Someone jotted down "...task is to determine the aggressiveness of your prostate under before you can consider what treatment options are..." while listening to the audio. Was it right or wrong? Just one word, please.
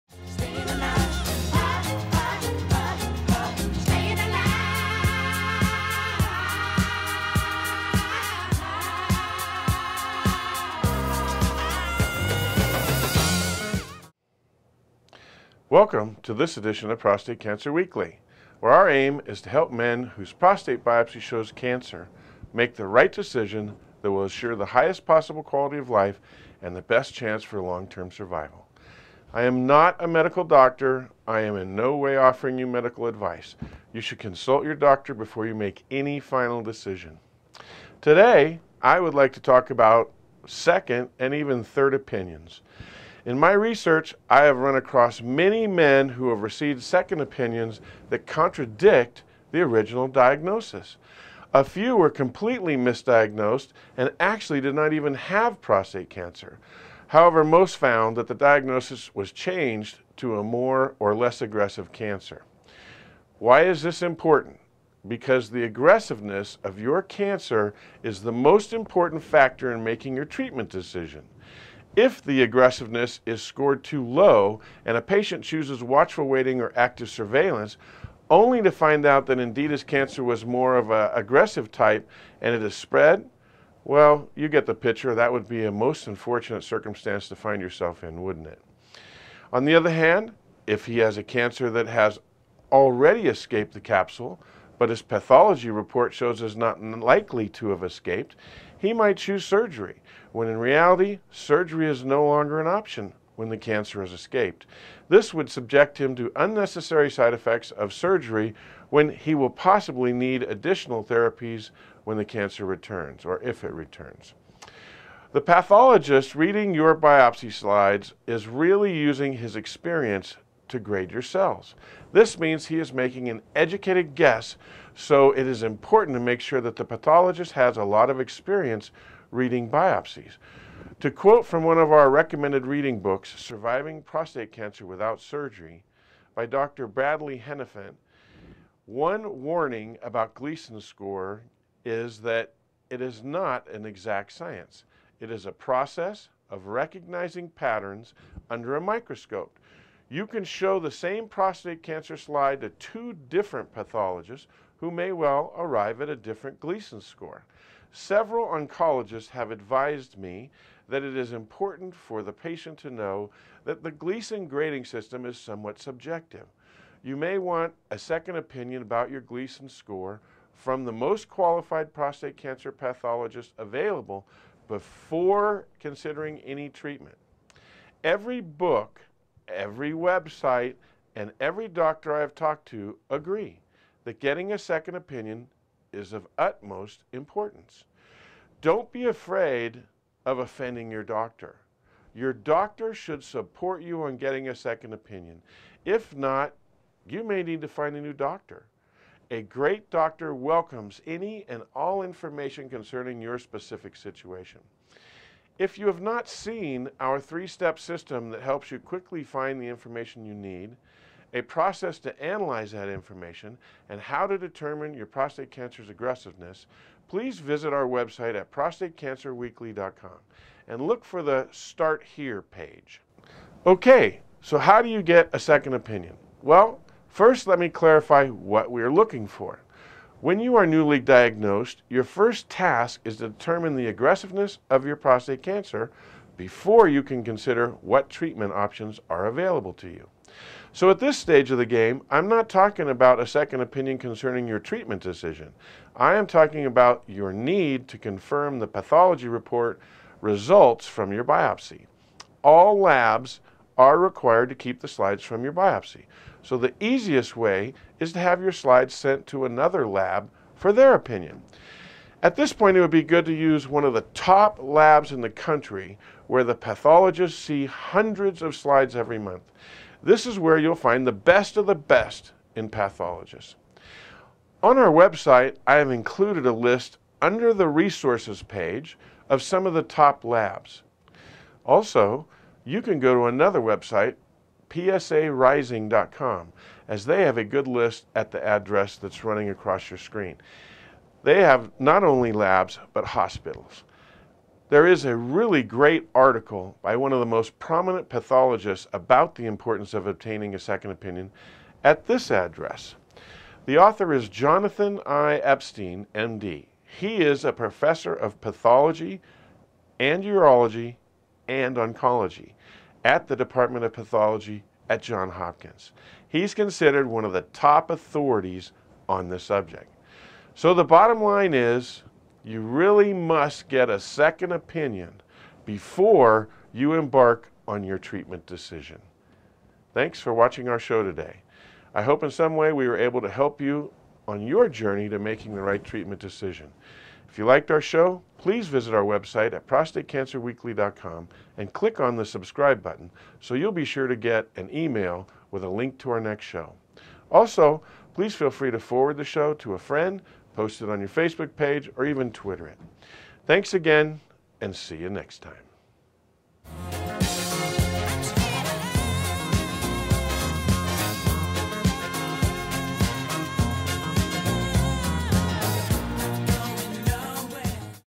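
wrong.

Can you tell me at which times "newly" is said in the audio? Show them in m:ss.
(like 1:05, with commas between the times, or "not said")
3:50.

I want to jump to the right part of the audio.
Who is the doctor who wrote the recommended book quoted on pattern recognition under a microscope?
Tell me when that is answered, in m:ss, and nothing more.
2:16.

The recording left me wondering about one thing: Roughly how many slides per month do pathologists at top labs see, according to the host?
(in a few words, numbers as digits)
Hundreds.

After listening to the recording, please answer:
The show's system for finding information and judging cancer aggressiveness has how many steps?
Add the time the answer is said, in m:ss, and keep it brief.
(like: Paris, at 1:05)
3, at 3:27.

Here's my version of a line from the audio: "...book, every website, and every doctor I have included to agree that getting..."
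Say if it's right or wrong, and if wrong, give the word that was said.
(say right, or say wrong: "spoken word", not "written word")
wrong: "talked", not "included".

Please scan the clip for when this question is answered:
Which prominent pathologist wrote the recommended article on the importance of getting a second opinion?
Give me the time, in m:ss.
5:04.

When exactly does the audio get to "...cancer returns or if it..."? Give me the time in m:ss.
1:52.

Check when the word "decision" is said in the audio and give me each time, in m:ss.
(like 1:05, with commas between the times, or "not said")
0:23, 0:36, 1:10, 4:05, 5:28, 5:36.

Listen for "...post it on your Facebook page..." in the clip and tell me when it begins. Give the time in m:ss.
5:50.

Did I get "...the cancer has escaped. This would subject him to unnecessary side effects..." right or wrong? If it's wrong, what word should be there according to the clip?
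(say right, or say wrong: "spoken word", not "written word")
right.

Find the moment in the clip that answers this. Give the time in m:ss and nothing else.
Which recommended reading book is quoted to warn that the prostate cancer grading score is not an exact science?
2:13.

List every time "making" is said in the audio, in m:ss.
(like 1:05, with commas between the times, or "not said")
1:09, 2:02, 5:35.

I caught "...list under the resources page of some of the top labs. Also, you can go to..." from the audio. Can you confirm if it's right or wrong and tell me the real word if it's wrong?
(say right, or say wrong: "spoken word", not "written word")
right.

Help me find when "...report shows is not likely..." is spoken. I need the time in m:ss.
1:35.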